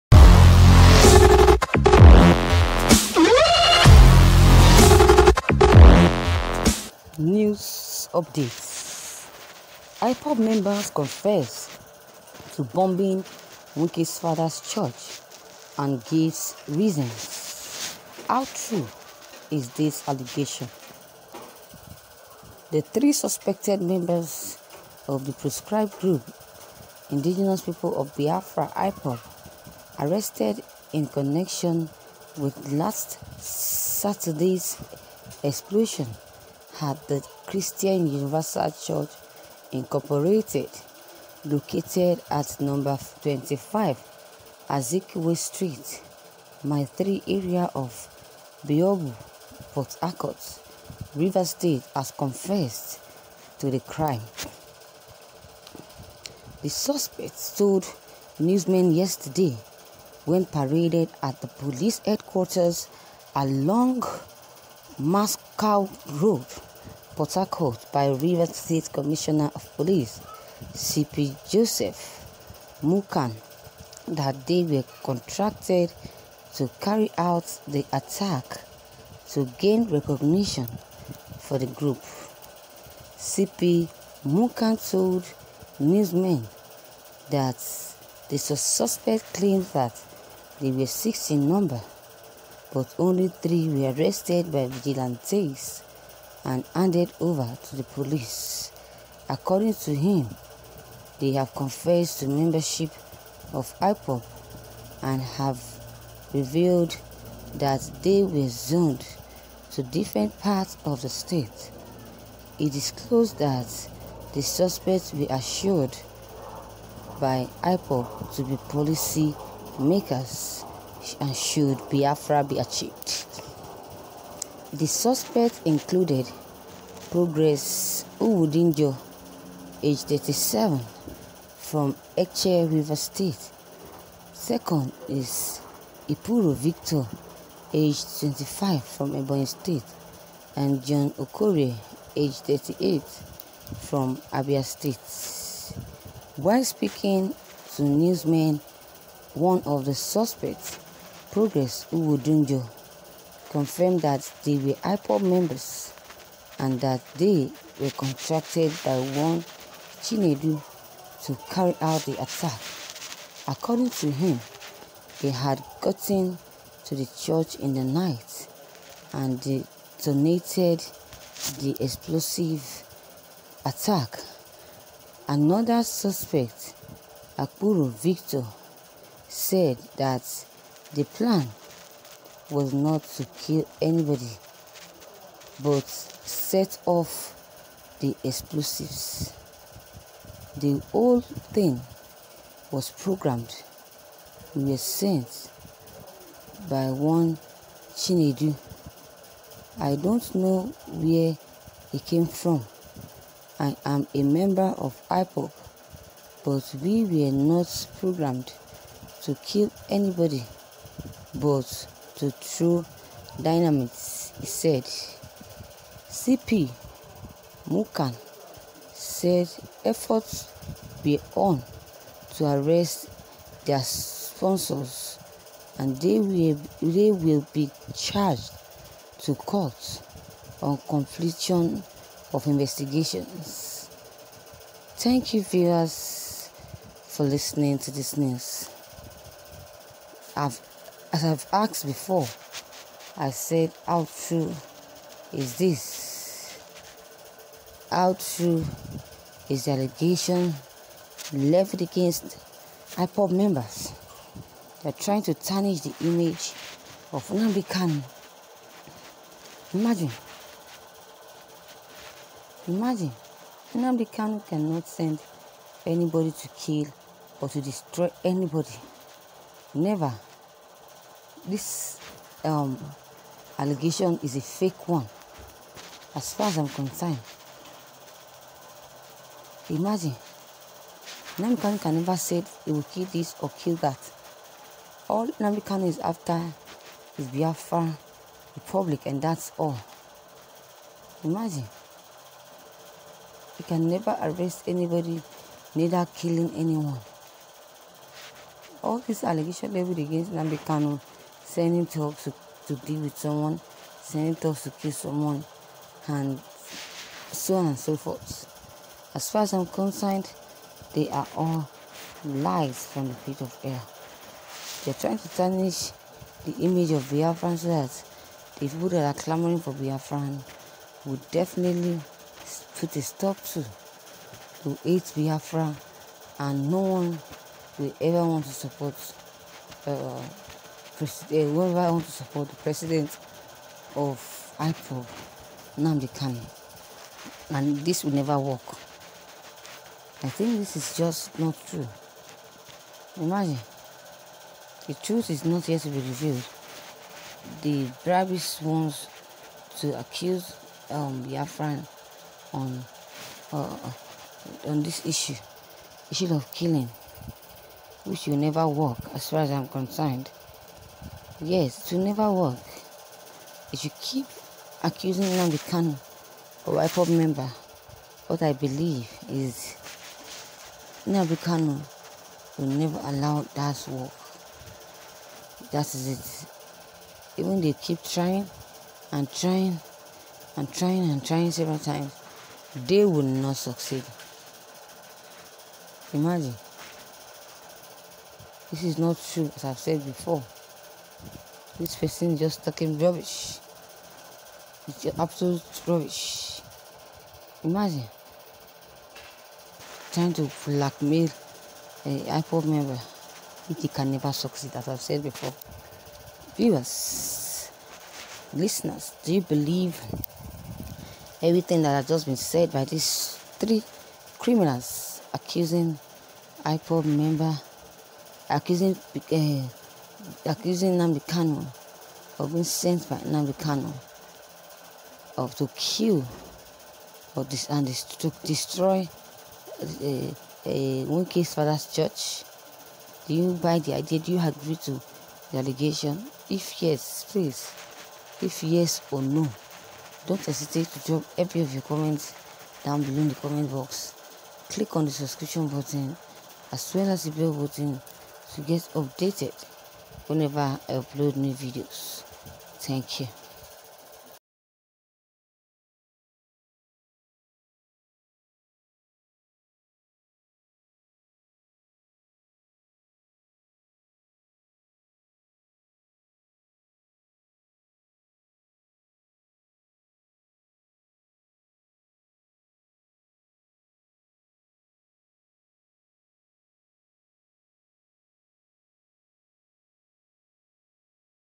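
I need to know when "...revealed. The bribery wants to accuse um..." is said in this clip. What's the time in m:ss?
5:45.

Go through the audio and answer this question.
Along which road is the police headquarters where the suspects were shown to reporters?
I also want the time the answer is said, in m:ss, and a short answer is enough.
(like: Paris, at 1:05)
Moscow Road, at 1:05.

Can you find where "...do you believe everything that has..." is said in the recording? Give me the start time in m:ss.
6:49.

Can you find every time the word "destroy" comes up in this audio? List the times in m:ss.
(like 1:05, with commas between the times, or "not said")
4:27, 7:08.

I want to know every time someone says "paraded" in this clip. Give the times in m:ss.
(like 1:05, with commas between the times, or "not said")
1:00.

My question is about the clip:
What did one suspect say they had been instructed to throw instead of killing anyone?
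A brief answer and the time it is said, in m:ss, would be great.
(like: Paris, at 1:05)
Dynamite, at 3:33.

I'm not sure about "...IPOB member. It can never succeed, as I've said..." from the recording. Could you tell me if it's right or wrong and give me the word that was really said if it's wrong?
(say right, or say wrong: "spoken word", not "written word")
right.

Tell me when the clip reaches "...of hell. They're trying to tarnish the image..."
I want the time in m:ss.
5:13.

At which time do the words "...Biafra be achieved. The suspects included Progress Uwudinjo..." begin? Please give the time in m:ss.
2:01.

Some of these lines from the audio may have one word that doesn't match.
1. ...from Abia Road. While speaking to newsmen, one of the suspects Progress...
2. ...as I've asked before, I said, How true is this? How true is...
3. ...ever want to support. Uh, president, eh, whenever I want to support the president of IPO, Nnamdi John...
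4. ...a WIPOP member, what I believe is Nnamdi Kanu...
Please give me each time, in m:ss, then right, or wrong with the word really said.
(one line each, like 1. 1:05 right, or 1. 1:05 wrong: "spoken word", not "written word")
1. 2:23 wrong: "State", not "Road"
2. 4:01 right
3. 5:27 wrong: "Kanu", not "John"
4. 6:06 right.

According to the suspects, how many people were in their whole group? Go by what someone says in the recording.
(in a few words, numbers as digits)
6.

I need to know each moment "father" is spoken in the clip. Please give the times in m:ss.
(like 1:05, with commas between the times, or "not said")
0:14, 7:11.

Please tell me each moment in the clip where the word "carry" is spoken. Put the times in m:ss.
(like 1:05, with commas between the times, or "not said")
1:16, 2:41.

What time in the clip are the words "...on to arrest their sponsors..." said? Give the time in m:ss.
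3:41.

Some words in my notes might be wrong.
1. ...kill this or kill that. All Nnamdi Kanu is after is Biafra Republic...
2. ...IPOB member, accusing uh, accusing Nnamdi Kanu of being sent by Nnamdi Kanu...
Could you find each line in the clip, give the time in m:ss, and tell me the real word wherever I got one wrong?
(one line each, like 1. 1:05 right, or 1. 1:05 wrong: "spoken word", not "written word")
1. 4:42 right
2. 6:56 right.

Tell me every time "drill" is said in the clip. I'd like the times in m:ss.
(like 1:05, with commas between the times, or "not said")
not said.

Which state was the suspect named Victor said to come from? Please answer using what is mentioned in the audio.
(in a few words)
Ebonyi State.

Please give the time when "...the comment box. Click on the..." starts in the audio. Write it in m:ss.
7:23.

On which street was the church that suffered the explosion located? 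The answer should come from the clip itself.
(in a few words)
Azikiwe Street.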